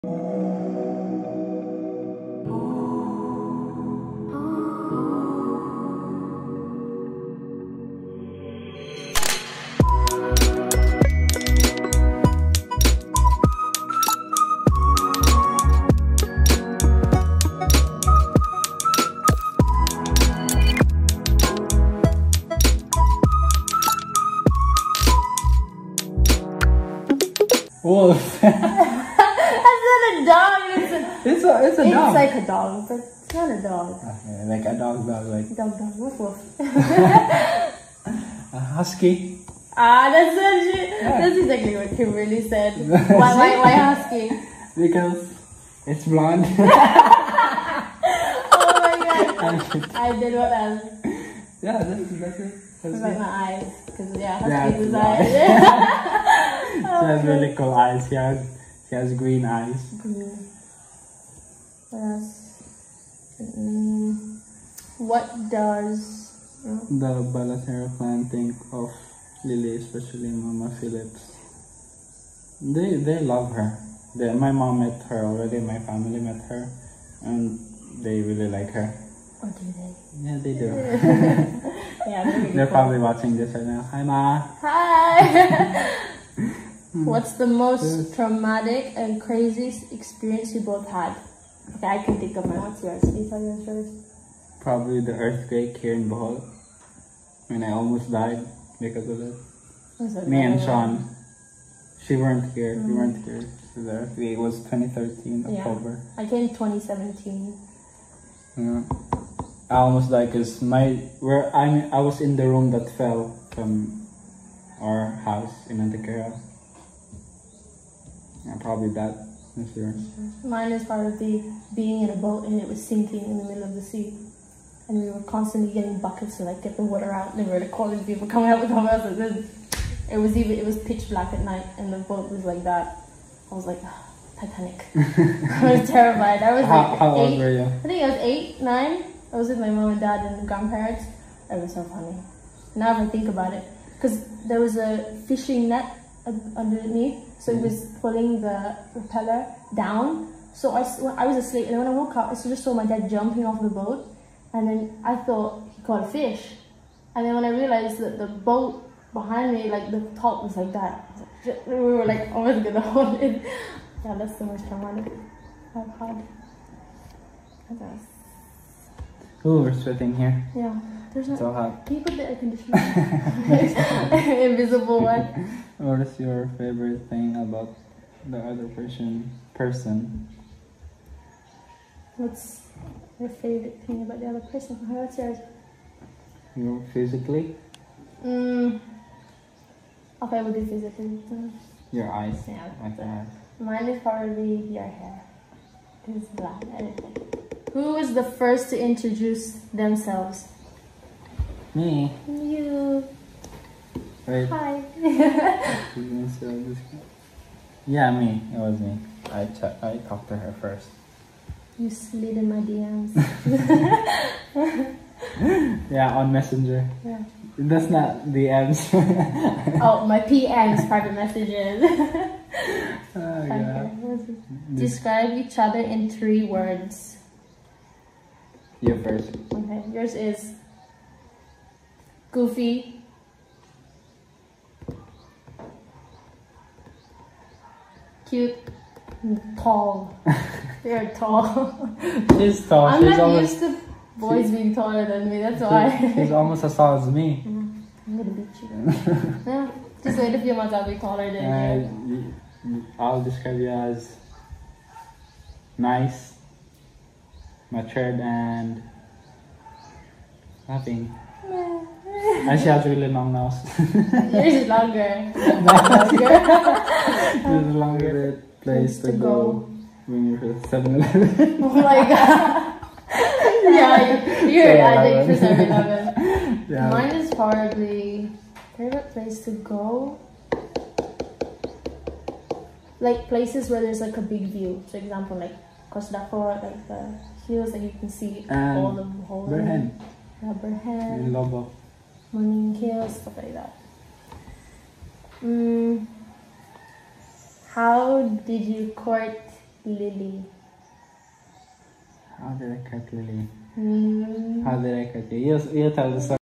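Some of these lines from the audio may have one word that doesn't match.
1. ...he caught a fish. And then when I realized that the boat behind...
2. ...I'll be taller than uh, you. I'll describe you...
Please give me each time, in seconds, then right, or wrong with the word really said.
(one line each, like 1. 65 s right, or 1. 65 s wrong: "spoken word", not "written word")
1. 155 s right
2. 250 s right.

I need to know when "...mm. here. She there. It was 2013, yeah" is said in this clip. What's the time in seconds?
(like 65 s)
103 s.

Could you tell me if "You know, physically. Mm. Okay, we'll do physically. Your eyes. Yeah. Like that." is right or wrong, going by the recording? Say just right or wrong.
right.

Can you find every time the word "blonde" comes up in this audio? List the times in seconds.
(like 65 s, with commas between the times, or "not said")
46 s.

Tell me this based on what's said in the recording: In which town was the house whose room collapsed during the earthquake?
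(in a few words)
Antequera.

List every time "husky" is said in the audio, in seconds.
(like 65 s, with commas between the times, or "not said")
38 s, 43 s, 54 s.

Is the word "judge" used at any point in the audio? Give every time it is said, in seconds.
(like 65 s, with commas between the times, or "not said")
not said.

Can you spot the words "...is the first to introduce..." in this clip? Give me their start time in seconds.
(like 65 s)
197 s.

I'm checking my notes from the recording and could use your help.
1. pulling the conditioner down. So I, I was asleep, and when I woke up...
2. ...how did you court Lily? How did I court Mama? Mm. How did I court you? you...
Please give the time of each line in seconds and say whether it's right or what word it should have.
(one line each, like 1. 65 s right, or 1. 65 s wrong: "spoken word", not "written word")
1. 148 s wrong: "propeller", not "conditioner"
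2. 297 s wrong: "Lily", not "Mama".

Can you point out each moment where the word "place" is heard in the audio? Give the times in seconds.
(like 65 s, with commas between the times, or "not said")
268 s, 279 s, 283 s.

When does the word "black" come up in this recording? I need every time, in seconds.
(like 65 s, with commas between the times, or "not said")
131 s, 196 s.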